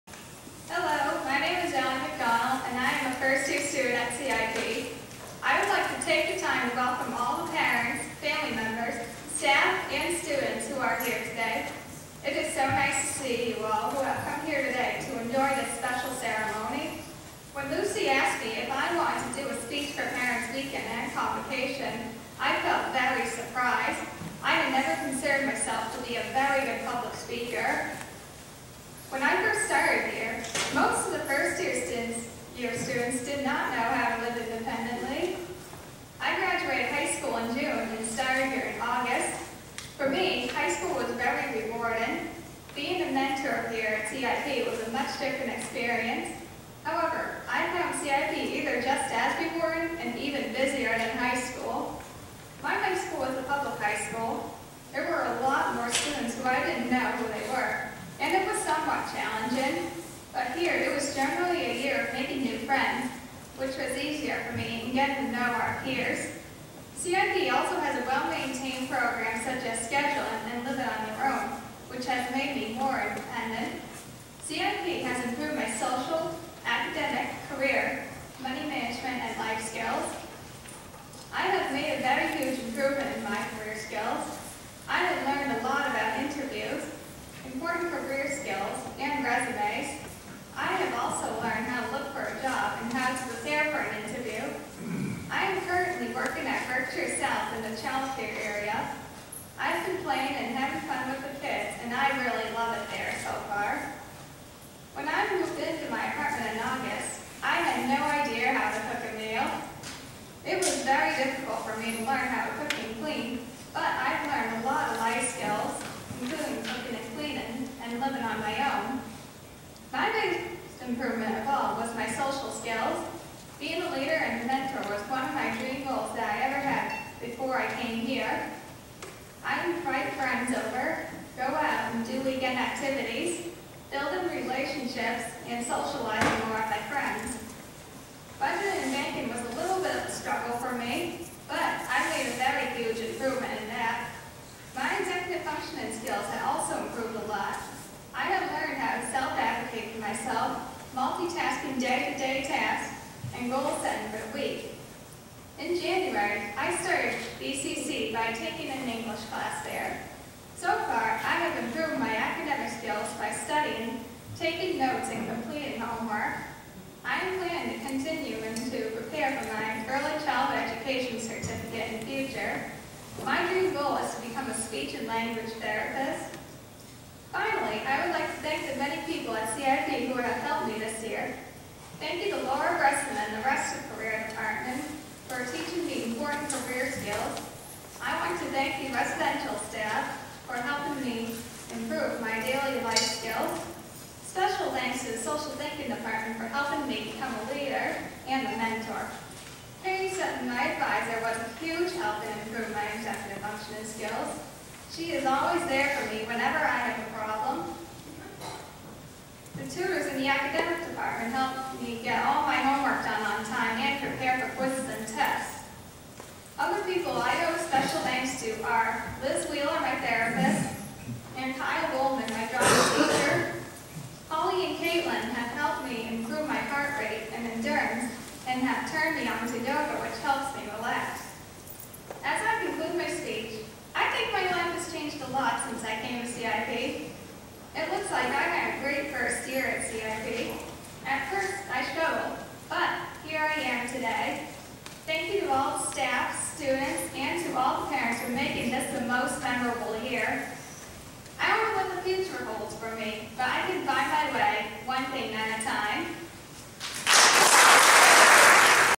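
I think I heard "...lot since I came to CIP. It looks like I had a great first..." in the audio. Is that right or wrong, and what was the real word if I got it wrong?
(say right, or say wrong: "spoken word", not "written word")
right.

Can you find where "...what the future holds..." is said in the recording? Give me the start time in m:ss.
4:11.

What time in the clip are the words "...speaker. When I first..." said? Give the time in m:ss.
0:27.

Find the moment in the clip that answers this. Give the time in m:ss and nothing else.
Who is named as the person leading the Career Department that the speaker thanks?
3:02.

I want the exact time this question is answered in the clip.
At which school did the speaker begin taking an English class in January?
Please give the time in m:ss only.
2:37.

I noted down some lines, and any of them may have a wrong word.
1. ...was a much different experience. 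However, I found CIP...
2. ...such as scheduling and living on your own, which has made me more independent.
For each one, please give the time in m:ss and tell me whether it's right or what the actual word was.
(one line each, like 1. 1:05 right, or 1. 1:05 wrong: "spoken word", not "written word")
1. 0:44 right
2. 1:09 right.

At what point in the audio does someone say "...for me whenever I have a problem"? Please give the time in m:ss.
3:25.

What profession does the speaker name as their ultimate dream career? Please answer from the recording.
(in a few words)
speech and language therapist.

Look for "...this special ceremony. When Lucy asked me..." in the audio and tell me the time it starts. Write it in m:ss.
0:15.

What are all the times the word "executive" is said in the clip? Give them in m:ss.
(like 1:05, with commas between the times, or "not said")
2:24, 3:22.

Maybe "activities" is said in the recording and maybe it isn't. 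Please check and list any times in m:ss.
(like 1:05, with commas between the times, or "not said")
2:12.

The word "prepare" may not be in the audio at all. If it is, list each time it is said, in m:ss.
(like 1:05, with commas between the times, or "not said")
2:48, 3:34.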